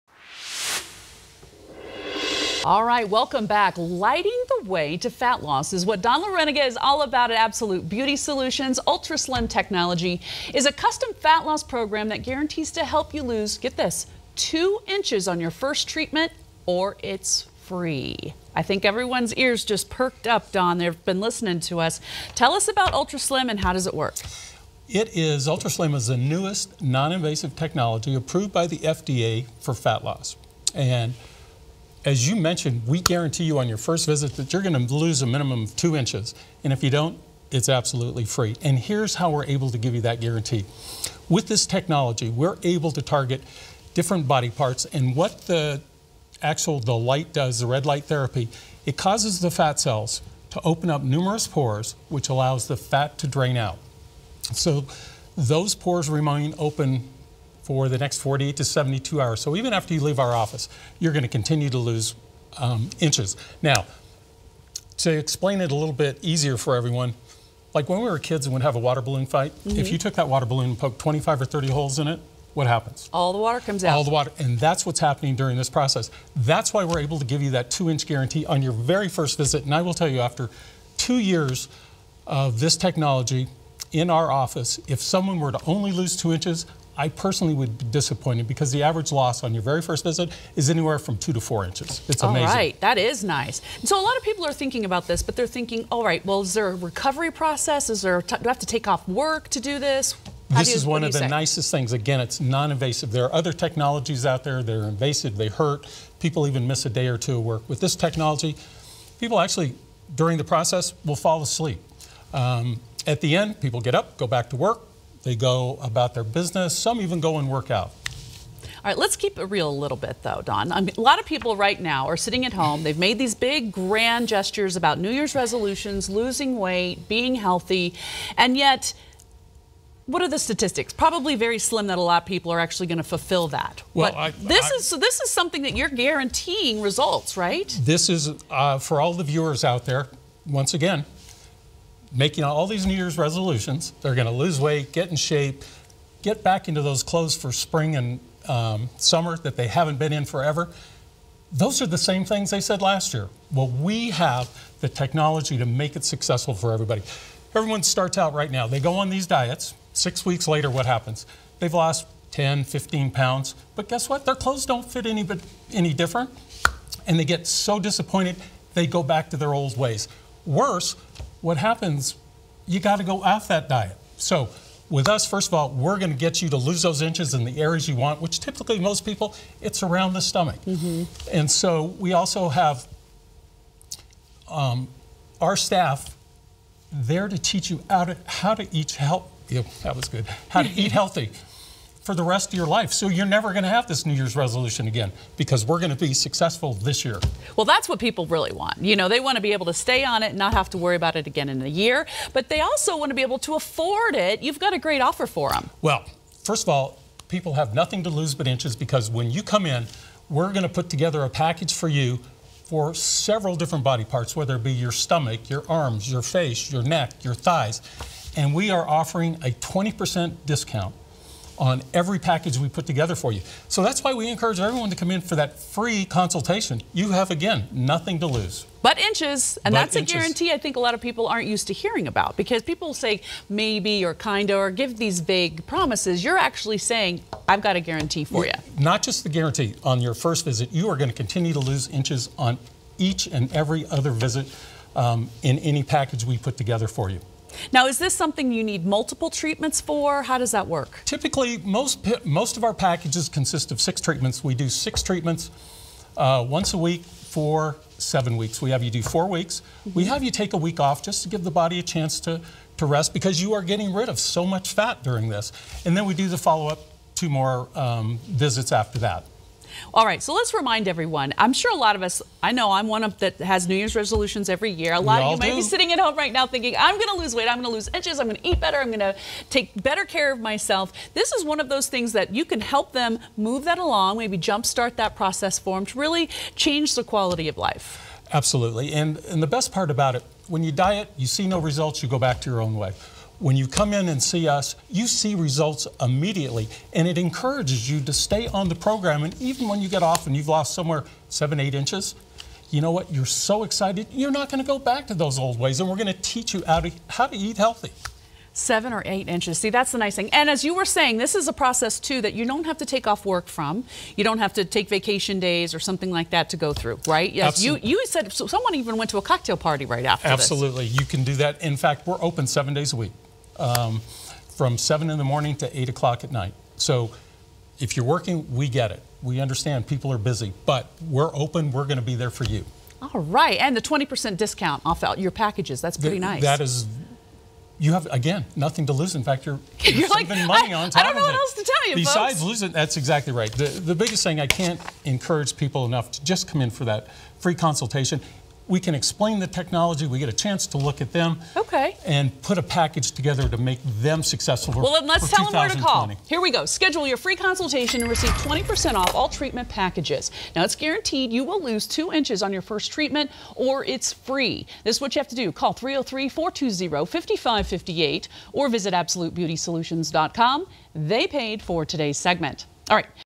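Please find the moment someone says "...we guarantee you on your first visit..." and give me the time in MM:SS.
00:32.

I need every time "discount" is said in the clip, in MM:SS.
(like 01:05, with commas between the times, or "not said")
03:40, 05:34.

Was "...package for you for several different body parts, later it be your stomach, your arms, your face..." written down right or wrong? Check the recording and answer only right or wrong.
wrong.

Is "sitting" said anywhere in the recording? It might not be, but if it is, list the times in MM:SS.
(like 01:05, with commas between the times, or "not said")
02:02, 04:35.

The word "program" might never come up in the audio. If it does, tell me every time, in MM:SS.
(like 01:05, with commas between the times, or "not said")
00:11, 04:58.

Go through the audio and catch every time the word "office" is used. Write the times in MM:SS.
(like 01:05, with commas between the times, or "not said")
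01:00, 01:24.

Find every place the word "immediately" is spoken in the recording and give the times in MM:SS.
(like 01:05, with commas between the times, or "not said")
04:55.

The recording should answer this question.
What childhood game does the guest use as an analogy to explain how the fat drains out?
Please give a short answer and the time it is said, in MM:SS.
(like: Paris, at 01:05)
water balloon fight, at 01:08.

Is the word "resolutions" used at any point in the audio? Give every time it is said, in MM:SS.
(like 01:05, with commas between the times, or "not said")
02:05, 02:23, 03:14, 04:33.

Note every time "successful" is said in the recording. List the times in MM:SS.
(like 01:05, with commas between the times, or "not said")
02:36, 03:16, 05:54.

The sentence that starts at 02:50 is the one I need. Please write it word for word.
Worse, what happens, you got to go off that diet.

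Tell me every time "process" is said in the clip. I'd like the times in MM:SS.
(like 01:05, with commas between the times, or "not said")
01:15, 01:37, 01:50, 04:45, 05:11.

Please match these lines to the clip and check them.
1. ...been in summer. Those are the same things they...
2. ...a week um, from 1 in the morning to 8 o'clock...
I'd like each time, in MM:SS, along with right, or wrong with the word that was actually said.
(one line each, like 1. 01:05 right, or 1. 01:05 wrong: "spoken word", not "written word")
1. 02:29 wrong: "forever", not "summer"
2. 05:22 wrong: "7", not "1".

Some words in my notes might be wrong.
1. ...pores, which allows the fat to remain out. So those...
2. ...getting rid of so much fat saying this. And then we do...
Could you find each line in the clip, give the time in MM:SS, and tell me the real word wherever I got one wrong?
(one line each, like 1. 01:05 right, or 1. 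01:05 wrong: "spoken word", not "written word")
1. 00:51 wrong: "drain", not "remain"
2. 04:23 wrong: "during", not "saying".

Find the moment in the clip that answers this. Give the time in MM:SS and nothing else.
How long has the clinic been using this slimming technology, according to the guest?
01:20.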